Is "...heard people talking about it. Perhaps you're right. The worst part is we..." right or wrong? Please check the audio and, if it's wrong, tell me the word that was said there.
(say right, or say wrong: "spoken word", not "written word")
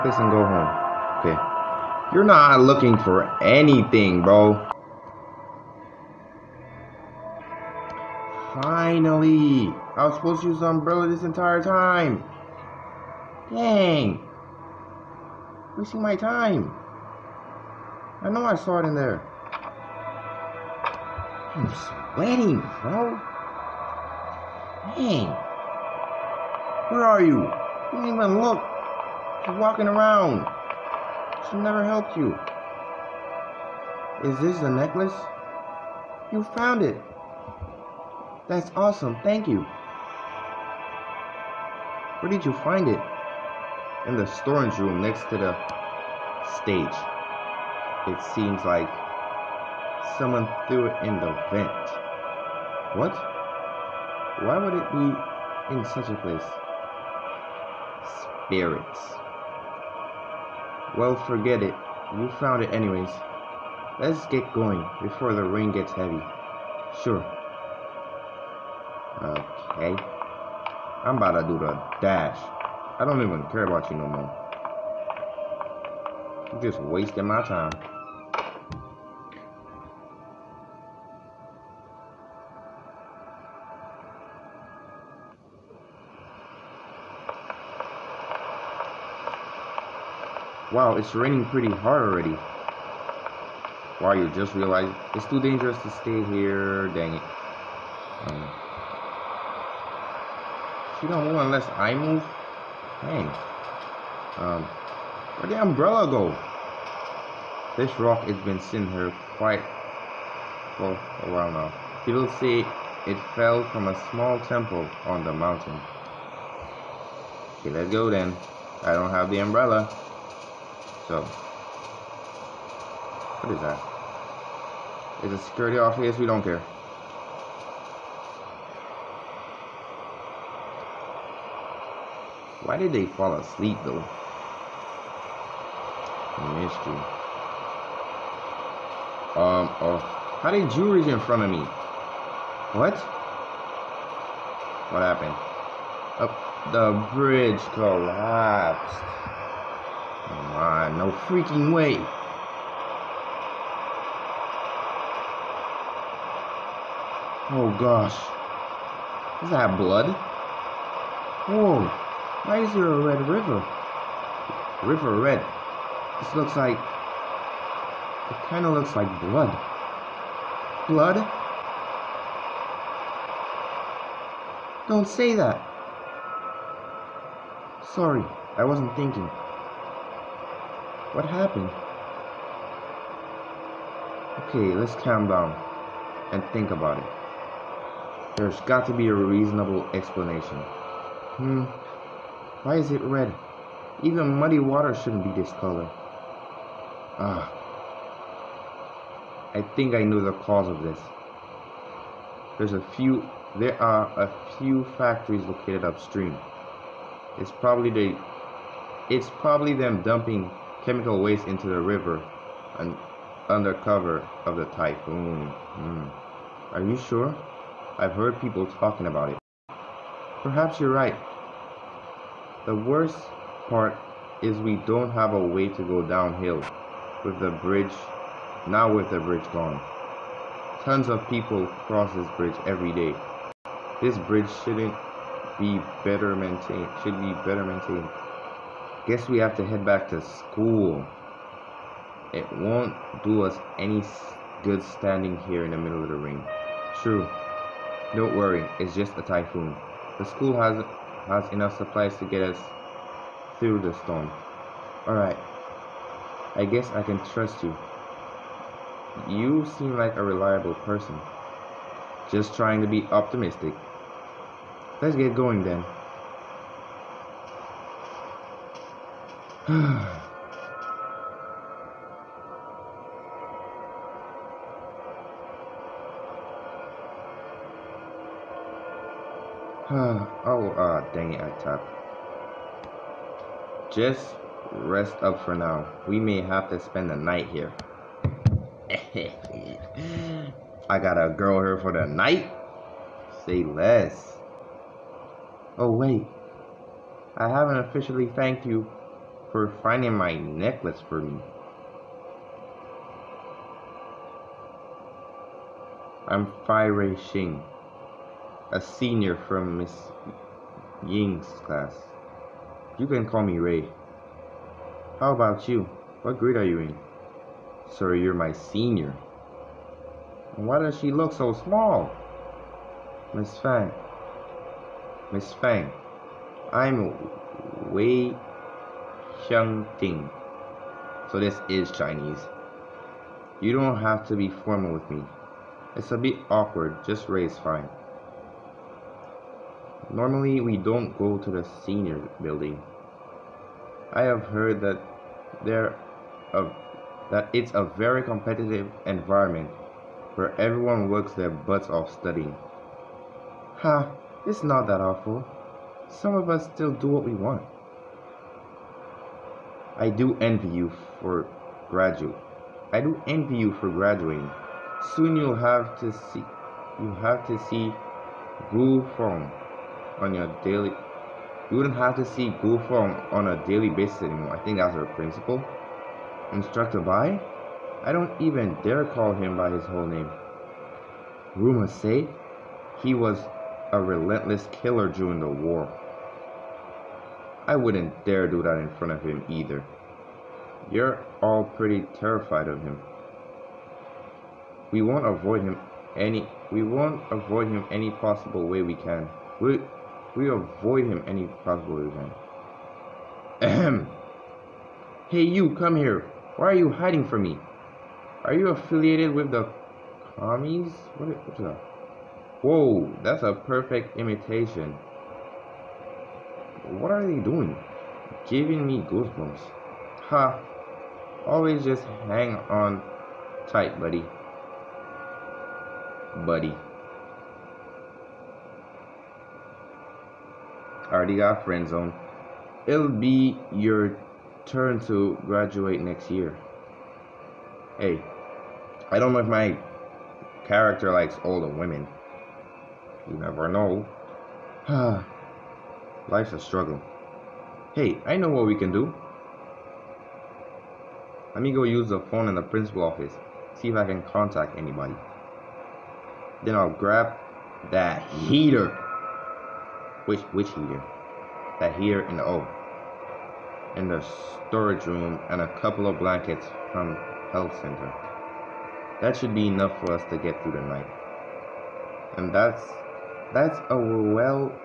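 right.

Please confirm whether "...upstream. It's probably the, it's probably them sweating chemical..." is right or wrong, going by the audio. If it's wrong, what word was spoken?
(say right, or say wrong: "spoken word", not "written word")
wrong: "dumping", not "sweating".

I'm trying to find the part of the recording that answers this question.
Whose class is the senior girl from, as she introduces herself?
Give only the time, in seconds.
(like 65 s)
309 s.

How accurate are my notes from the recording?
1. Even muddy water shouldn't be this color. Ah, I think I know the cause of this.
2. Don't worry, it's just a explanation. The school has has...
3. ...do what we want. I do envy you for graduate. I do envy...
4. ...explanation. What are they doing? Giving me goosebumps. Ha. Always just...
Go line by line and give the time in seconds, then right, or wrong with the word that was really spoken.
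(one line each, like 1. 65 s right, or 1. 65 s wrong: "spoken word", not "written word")
1. 194 s right
2. 248 s wrong: "typhoon", not "explanation"
3. 356 s right
4. 414 s wrong: "imitation", not "explanation".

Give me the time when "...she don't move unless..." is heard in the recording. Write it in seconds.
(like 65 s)
101 s.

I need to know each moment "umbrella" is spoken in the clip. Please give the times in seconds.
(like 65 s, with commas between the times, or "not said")
10 s, 105 s, 119 s.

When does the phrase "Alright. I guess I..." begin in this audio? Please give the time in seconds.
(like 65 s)
255 s.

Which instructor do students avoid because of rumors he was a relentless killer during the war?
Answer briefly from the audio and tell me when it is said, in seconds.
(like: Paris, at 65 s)
Instructor Bai, at 376 s.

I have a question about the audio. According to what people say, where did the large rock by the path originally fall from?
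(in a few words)
A small temple on the mountain.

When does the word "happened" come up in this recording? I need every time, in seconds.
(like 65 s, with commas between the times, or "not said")
145 s, 181 s.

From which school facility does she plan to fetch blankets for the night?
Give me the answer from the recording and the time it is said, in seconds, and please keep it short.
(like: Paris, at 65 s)
Health center, at 467 s.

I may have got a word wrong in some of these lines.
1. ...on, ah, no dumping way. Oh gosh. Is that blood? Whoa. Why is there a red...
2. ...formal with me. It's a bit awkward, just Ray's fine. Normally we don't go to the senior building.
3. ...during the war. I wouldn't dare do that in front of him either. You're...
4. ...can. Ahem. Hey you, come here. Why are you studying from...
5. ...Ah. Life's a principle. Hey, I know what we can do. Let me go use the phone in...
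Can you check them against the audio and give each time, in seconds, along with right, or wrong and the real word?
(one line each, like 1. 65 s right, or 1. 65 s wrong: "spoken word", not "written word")
1. 150 s wrong: "freaking", not "dumping"
2. 334 s right
3. 385 s right
4. 402 s wrong: "hiding", not "studying"
5. 444 s wrong: "struggle", not "principle".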